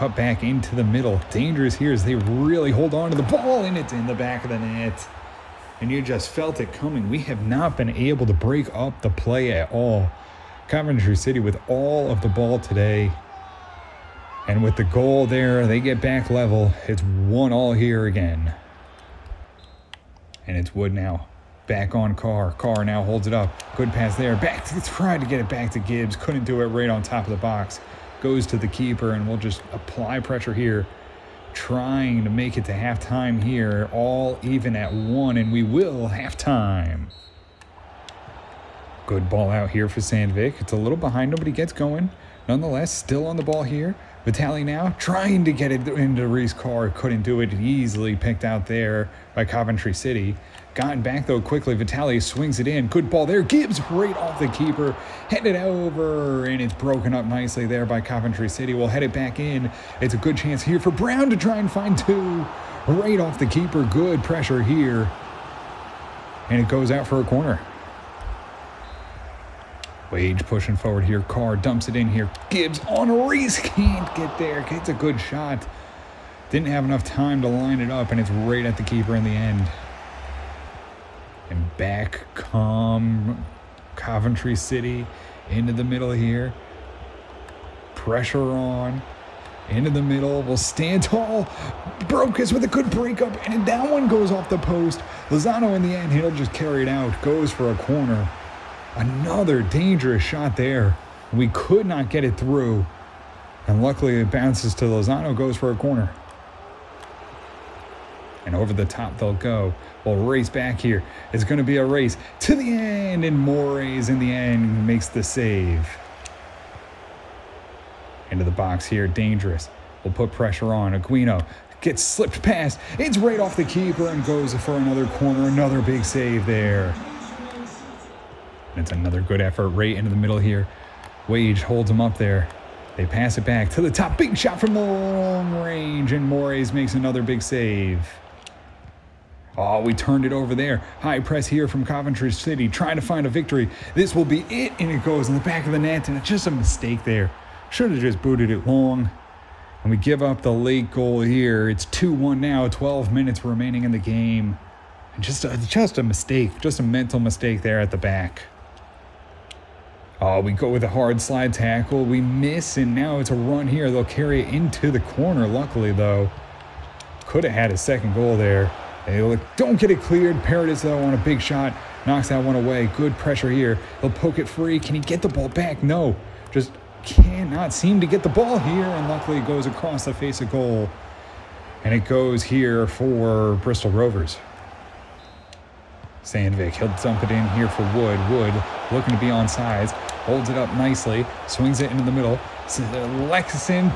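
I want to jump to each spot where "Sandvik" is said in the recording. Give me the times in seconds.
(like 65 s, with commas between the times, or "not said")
39 s, 186 s.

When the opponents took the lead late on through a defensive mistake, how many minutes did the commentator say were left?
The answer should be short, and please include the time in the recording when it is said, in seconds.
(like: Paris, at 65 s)
12, at 152 s.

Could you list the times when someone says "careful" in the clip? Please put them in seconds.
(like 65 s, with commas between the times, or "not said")
not said.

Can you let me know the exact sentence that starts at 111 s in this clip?
It's going to be a race to the end, and Moraes in the end makes the save.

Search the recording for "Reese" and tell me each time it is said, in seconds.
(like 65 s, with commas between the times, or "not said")
46 s, 73 s.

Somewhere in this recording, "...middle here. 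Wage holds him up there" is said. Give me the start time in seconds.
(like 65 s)
130 s.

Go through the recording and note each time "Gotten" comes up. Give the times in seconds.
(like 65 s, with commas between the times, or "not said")
50 s.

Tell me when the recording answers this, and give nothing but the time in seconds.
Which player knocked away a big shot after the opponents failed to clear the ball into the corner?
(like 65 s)
170 s.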